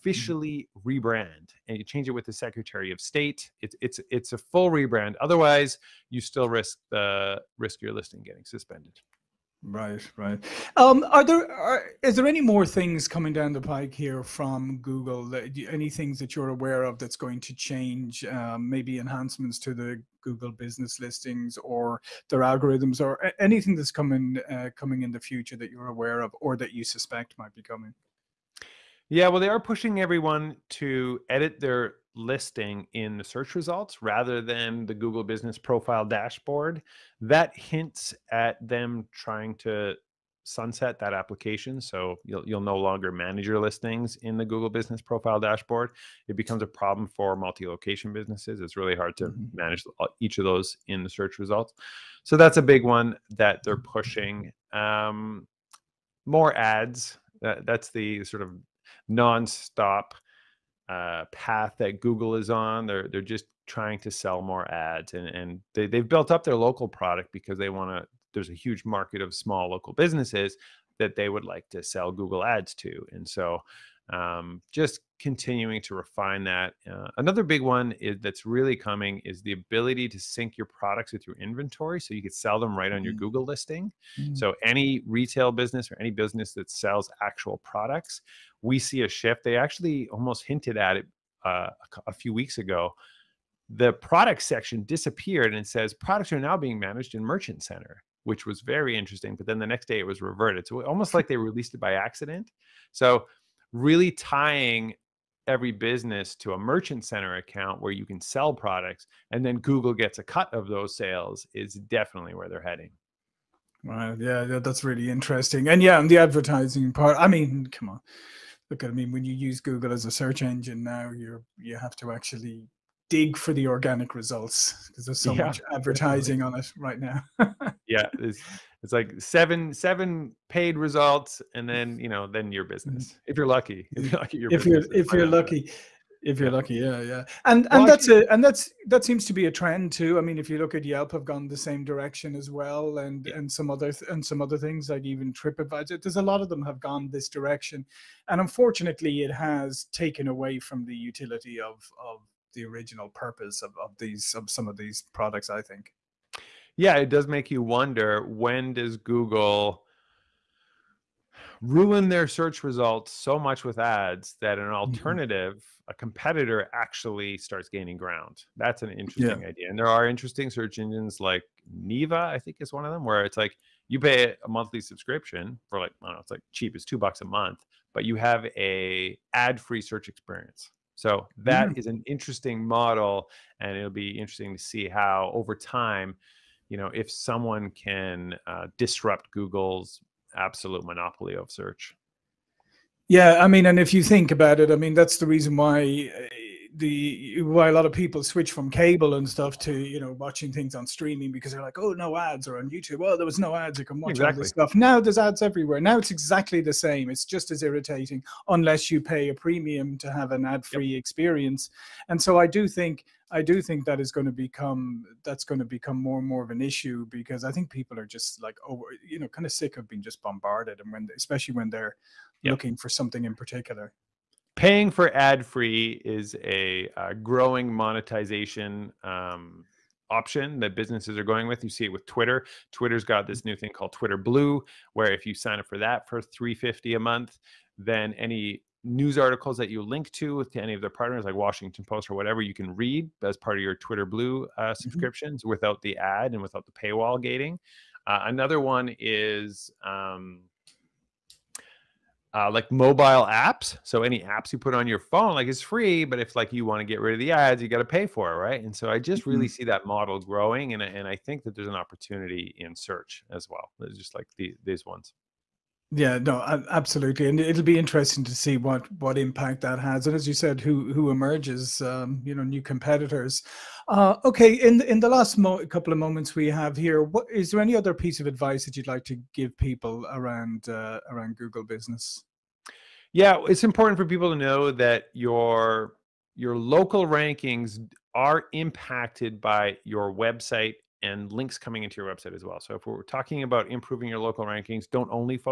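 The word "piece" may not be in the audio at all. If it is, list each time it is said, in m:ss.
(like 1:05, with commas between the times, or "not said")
4:37.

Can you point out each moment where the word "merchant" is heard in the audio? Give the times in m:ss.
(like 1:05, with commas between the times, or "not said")
1:37, 1:46.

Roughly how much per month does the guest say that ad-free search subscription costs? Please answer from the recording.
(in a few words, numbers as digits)
$2.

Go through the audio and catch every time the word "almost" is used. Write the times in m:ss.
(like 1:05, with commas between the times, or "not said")
1:30, 1:40.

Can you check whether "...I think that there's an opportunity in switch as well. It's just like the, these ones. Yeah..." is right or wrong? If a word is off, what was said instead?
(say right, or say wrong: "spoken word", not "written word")
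wrong: "search", not "switch".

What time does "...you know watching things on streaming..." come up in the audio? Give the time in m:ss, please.
3:19.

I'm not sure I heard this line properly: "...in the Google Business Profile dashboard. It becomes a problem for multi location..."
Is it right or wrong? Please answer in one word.
right.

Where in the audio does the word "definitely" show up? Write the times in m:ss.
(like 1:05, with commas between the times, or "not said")
1:51, 2:06.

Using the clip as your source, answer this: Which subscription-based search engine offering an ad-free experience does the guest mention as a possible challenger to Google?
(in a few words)
Neeva.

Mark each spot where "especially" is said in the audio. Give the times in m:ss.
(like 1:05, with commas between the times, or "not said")
3:41.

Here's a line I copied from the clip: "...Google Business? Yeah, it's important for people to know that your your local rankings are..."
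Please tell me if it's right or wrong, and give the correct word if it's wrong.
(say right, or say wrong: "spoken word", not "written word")
right.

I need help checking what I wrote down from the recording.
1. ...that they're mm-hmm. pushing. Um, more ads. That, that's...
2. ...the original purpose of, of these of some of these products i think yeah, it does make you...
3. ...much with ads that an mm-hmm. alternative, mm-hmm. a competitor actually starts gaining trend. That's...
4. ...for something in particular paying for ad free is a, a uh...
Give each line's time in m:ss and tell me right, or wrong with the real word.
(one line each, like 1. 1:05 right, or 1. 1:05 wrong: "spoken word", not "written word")
1. 0:53 right
2. 2:32 right
3. 2:43 wrong: "ground", not "trend"
4. 3:42 right.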